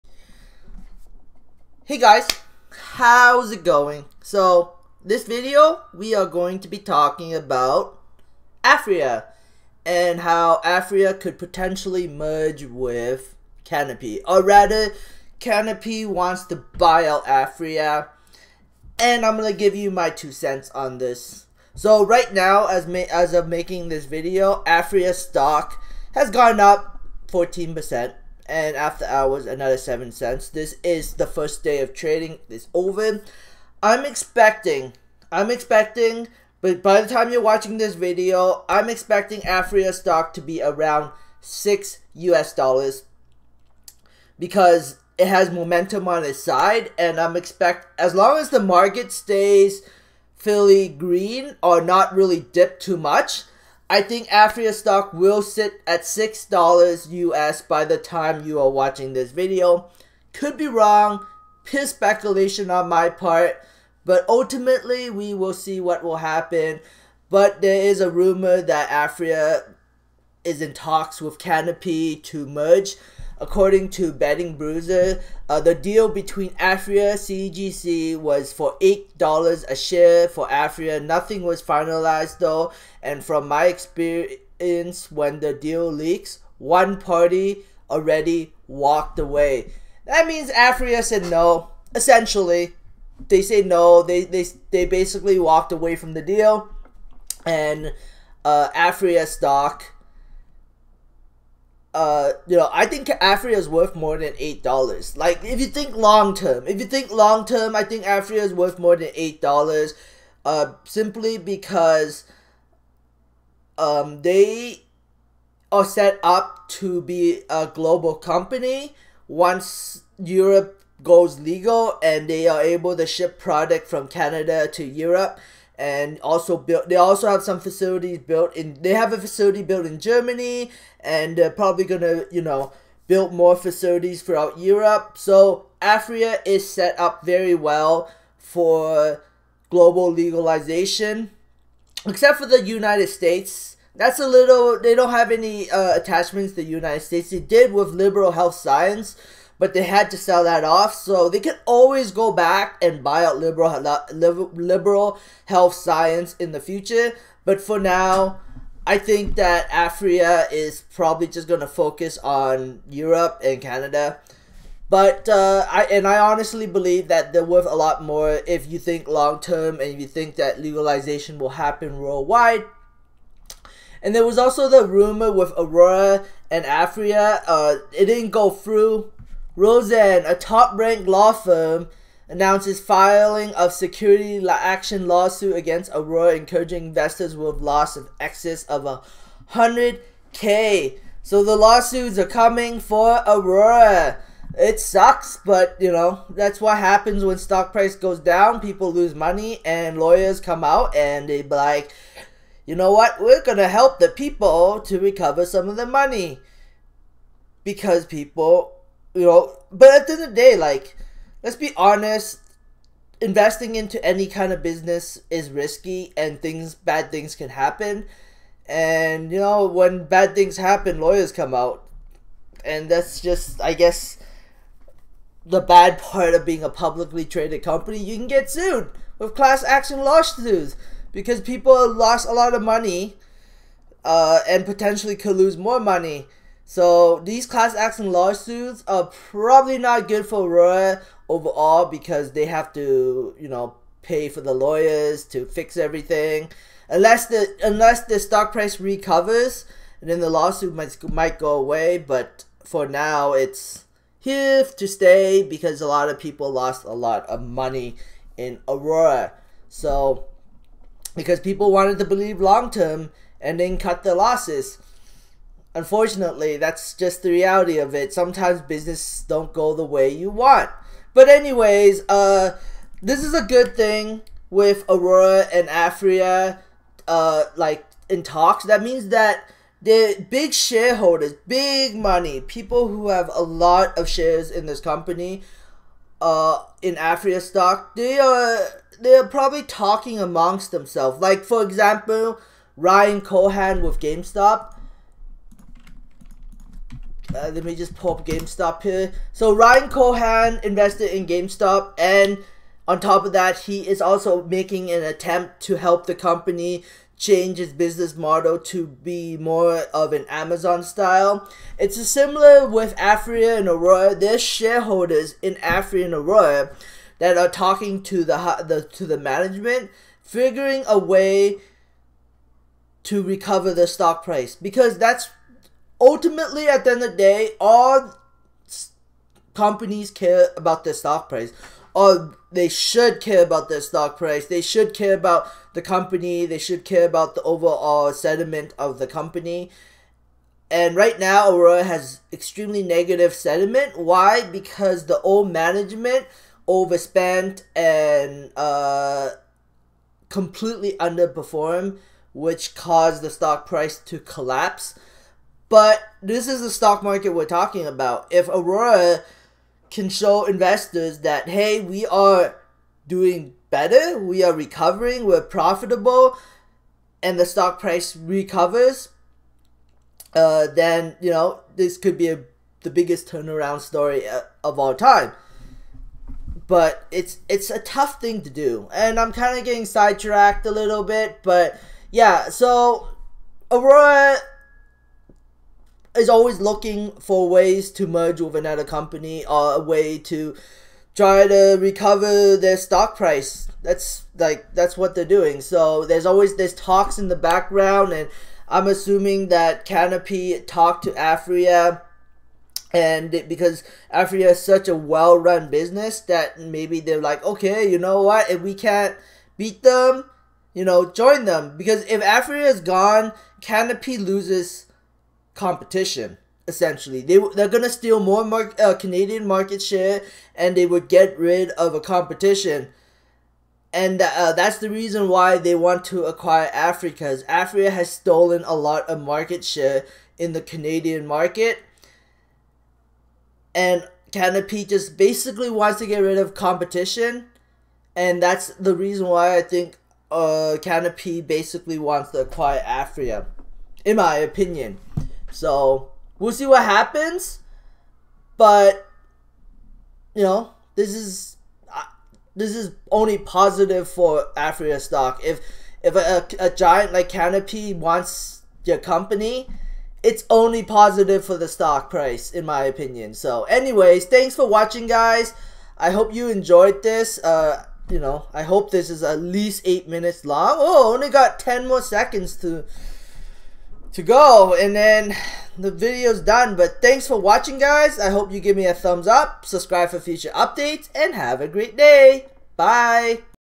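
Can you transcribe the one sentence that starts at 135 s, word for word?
So Aphria is set up very well for global legalization, except for the United States.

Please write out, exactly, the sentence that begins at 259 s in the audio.
So because people wanted to believe long term and then cut their losses.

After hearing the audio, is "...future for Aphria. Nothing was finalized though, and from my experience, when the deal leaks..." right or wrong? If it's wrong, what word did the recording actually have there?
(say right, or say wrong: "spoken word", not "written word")
wrong: "share", not "future".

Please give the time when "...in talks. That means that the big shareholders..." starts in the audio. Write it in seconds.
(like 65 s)
278 s.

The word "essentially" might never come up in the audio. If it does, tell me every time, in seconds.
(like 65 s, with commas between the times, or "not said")
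91 s, 416 s.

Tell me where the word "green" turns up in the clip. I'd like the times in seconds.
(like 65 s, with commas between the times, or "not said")
50 s.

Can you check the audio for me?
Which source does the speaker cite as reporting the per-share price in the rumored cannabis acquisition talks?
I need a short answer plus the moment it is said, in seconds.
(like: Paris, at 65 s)
Betting Bruiser, at 74 s.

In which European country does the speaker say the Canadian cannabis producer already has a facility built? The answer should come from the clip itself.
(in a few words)
Germany.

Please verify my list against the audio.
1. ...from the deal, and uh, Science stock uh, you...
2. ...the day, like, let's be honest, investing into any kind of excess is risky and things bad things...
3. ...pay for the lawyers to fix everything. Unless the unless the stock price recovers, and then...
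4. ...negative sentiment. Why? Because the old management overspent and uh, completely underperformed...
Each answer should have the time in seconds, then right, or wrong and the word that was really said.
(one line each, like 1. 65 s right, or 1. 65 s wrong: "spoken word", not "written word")
1. 95 s wrong: "Aphria", not "Science"
2. 210 s wrong: "business", not "excess"
3. 244 s right
4. 342 s right.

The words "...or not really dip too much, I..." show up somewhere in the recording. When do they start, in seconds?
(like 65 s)
51 s.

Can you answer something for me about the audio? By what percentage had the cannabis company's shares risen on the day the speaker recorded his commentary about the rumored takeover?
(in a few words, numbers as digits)
14%.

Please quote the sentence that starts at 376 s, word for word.
But it's it's a tough thing to do, and I'm kind of getting sidetracked a little bit.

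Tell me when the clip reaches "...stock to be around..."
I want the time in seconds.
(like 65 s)
39 s.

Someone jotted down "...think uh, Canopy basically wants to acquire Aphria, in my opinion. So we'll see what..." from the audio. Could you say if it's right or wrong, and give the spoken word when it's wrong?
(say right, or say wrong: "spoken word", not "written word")
right.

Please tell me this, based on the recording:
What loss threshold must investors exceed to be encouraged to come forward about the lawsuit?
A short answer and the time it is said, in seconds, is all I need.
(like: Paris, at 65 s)
100k, at 188 s.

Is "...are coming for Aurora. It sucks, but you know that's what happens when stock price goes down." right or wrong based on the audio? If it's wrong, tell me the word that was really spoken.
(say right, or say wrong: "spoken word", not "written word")
right.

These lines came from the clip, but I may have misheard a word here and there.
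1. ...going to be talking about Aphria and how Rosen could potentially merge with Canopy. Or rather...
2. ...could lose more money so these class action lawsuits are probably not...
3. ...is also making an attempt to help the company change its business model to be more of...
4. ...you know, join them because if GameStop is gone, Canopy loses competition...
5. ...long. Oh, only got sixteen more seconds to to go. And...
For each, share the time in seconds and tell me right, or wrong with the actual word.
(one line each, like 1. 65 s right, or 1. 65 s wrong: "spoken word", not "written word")
1. 6 s wrong: "Aphria", not "Rosen"
2. 235 s right
3. 303 s right
4. 410 s wrong: "Aphria", not "GameStop"
5. 470 s wrong: "ten", not "sixteen".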